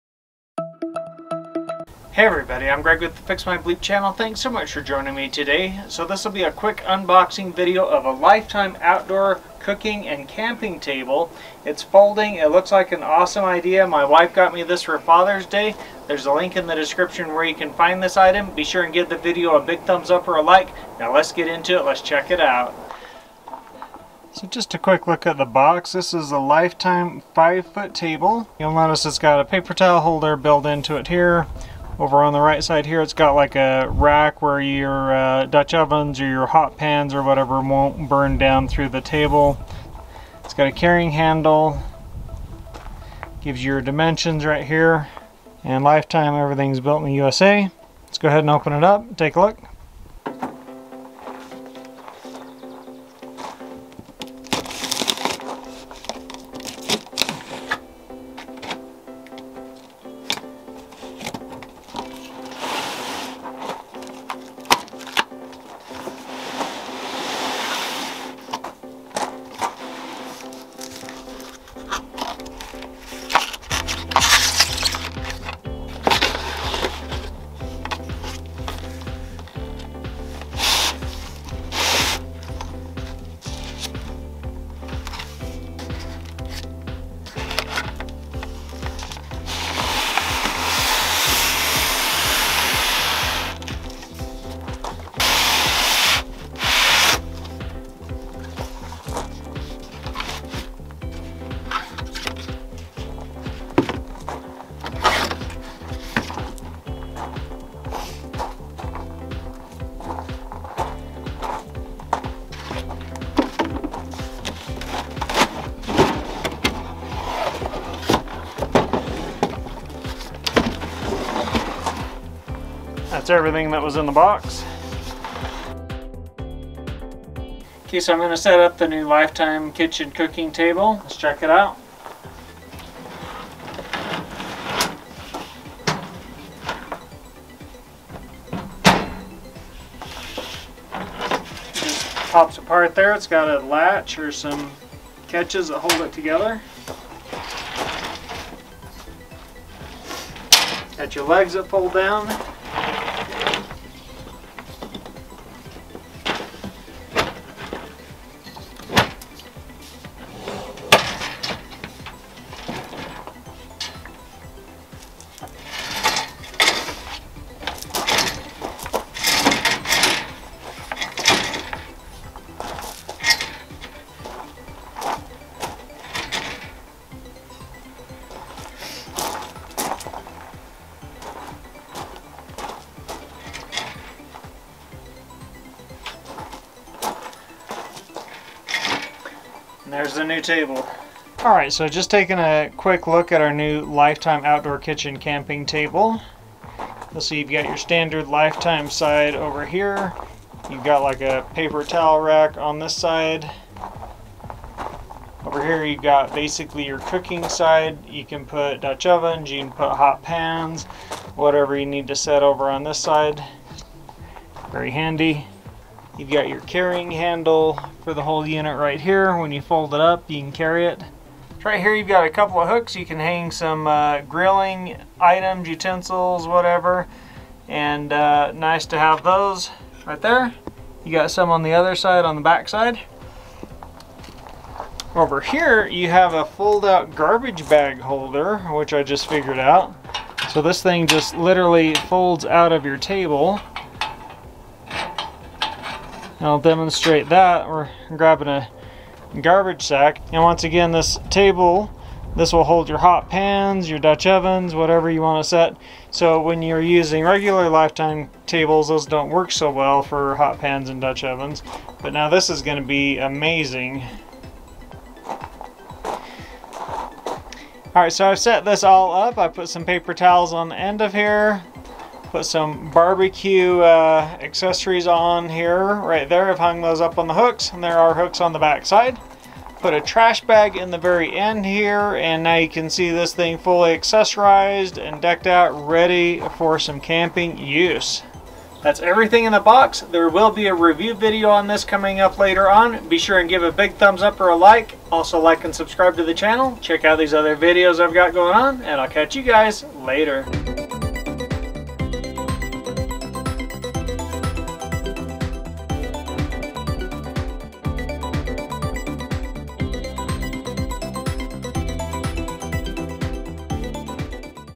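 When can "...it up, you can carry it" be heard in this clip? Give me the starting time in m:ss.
3:39.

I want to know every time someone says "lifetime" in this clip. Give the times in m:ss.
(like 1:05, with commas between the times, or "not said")
0:08, 0:26, 0:45, 2:09, 3:13, 3:18, 4:17.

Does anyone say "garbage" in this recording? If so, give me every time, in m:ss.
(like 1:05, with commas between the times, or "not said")
3:57, 4:09.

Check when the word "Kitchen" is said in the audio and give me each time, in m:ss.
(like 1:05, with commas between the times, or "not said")
2:09, 3:14.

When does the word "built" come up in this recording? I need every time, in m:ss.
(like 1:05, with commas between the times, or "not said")
0:30, 0:46.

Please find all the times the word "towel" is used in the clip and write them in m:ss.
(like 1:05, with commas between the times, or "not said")
0:29, 3:21, 4:30.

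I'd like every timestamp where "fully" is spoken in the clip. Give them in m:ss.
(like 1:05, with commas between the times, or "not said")
4:43.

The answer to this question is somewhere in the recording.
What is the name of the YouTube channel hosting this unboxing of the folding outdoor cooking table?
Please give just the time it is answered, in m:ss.
0:03.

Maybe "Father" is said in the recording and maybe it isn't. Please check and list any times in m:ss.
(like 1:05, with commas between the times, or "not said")
0:14.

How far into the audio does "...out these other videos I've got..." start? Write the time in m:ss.
4:57.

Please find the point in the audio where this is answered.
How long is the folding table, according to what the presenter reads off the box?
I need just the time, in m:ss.
0:27.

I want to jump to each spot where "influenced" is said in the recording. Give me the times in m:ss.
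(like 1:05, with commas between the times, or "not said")
not said.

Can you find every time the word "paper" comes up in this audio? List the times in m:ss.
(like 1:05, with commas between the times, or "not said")
0:29, 3:21, 4:29.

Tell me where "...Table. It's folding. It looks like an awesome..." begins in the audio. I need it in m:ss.
0:10.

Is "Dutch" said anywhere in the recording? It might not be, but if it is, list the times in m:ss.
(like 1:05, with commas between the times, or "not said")
0:35, 3:28, 4:13, 4:20.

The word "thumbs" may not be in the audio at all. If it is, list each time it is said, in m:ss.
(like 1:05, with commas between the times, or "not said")
0:19, 4:53.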